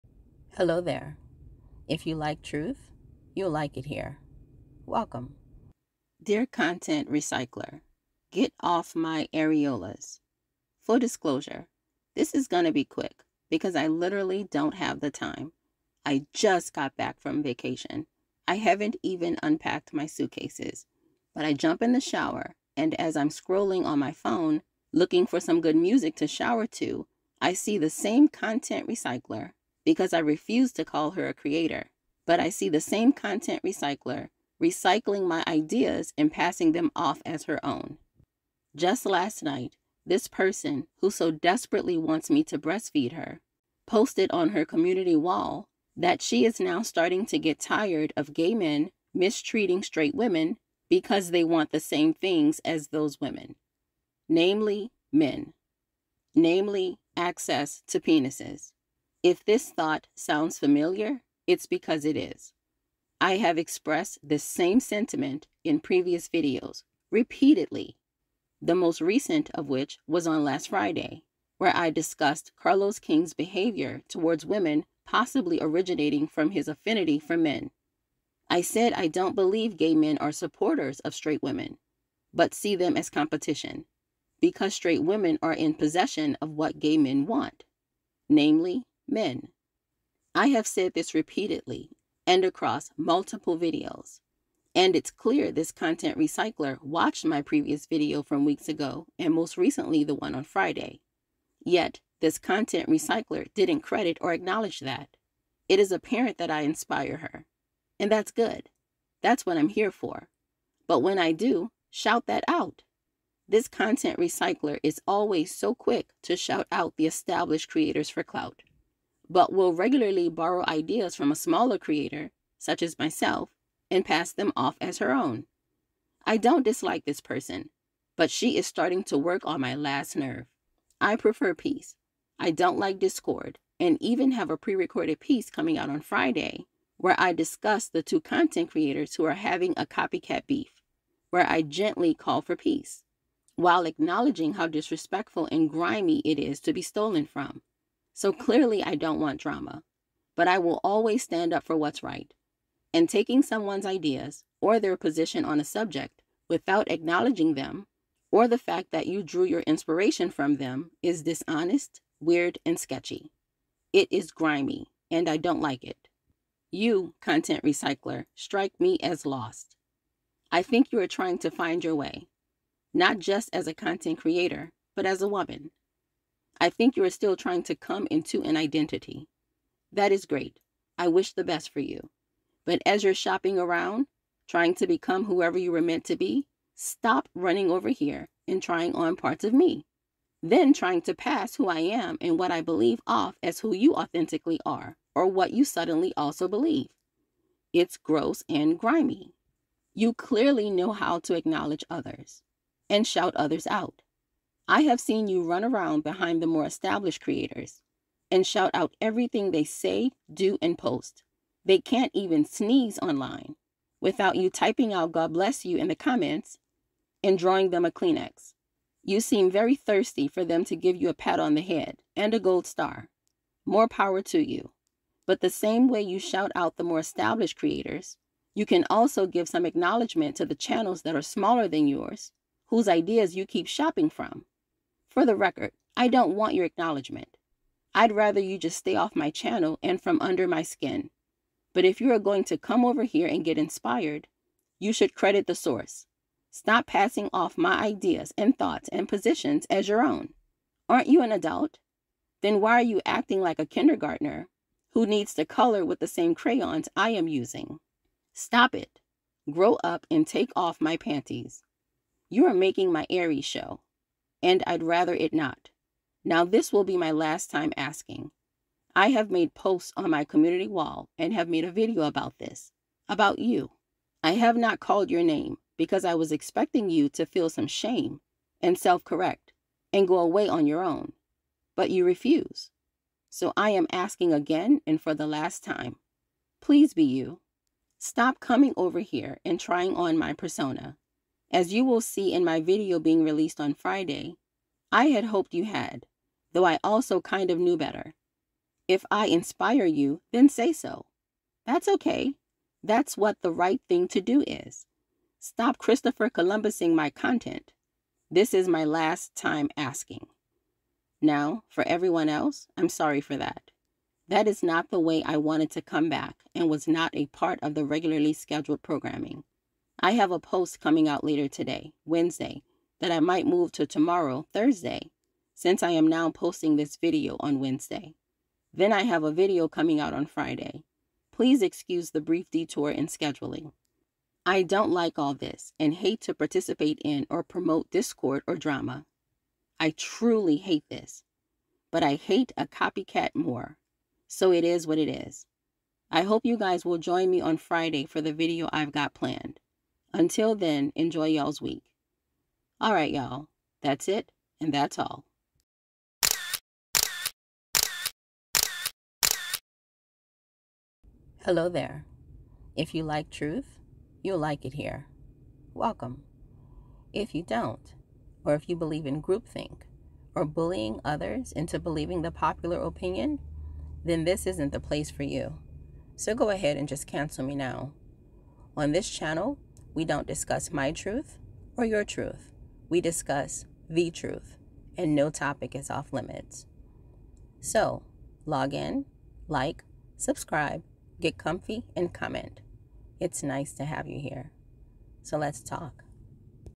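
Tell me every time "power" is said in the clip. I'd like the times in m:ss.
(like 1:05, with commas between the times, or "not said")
3:43.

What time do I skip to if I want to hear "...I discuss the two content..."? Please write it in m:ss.
2:17.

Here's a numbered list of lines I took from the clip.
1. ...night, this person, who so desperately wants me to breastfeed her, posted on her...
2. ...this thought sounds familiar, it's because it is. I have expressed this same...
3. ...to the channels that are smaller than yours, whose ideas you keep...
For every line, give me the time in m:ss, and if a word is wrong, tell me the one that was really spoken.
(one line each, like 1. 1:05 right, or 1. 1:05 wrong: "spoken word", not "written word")
1. 0:39 right
2. 0:59 right
3. 3:50 right.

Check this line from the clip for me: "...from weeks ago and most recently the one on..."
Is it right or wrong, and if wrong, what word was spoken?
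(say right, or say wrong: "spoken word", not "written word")
right.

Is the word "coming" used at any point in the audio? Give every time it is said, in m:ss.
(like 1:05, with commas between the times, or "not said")
2:15, 4:48, 5:20, 5:29.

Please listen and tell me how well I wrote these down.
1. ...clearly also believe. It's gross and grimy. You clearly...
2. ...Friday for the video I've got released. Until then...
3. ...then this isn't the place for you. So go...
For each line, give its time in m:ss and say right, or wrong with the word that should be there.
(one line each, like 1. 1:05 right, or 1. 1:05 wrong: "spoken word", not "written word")
1. 3:15 wrong: "suddenly", not "clearly"
2. 5:47 wrong: "planned", not "released"
3. 6:14 right.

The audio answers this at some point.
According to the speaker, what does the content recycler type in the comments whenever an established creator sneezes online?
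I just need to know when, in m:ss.
3:35.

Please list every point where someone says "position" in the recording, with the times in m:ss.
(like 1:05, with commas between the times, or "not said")
2:34, 4:09.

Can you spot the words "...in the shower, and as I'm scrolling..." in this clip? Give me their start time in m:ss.
0:21.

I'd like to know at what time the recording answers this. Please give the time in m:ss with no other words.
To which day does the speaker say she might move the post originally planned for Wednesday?
5:24.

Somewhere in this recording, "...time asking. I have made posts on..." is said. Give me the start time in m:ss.
4:27.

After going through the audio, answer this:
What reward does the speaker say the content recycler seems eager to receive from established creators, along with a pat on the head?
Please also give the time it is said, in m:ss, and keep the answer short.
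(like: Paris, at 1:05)
A gold star, at 3:42.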